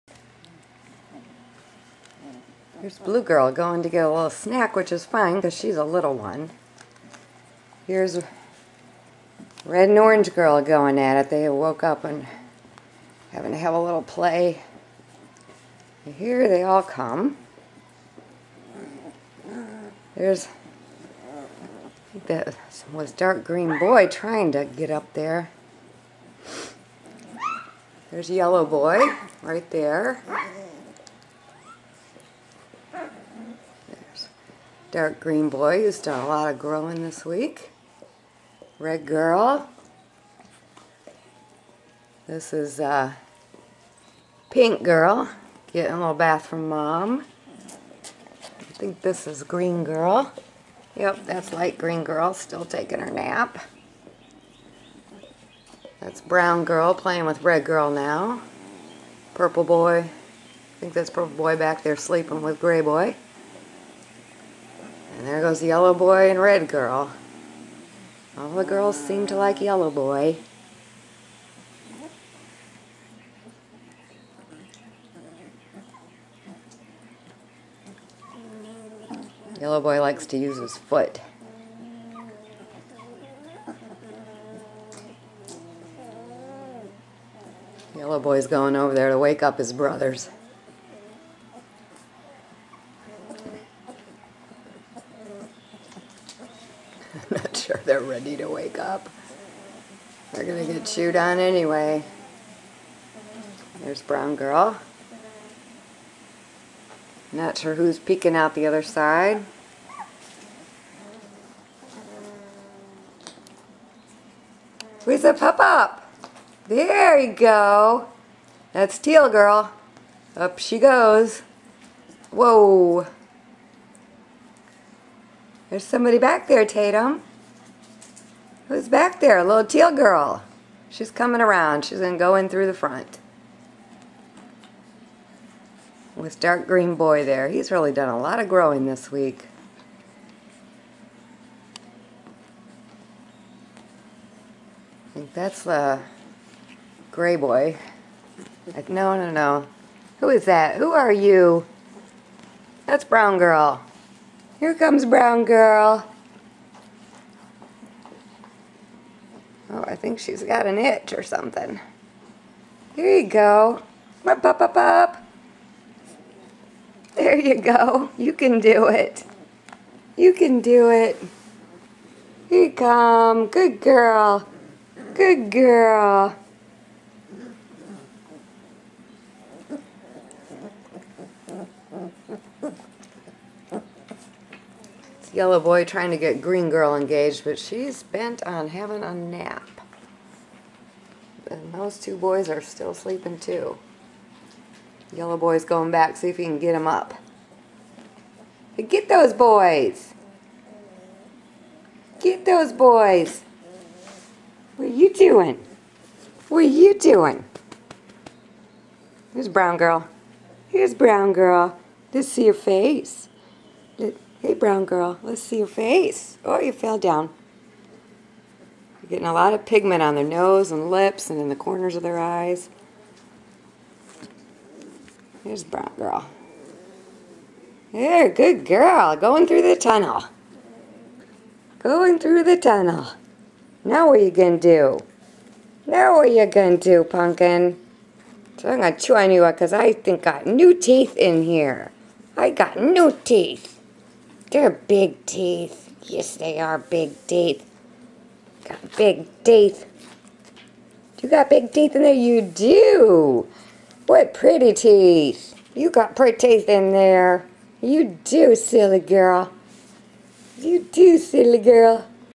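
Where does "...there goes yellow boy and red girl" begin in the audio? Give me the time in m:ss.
1:05.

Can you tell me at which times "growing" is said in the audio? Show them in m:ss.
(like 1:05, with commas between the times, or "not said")
0:36, 2:18.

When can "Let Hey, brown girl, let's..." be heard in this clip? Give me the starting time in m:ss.
3:33.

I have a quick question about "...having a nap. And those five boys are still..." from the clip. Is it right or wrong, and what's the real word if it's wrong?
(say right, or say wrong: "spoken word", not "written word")
wrong: "two", not "five".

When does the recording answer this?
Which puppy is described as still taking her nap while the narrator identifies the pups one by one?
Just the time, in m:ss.
0:51.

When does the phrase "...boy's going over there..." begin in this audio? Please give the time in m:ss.
1:28.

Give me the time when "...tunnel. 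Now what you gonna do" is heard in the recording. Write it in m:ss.
3:52.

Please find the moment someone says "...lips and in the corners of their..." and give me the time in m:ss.
3:40.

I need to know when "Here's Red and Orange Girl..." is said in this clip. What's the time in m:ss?
0:07.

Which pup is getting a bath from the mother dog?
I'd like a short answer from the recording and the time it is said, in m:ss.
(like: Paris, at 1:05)
Pink girl, at 0:44.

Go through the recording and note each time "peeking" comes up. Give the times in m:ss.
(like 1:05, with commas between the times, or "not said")
1:47.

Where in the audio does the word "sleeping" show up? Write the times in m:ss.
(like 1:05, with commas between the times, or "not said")
1:01, 3:12.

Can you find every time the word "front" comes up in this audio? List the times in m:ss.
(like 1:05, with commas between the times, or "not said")
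2:12.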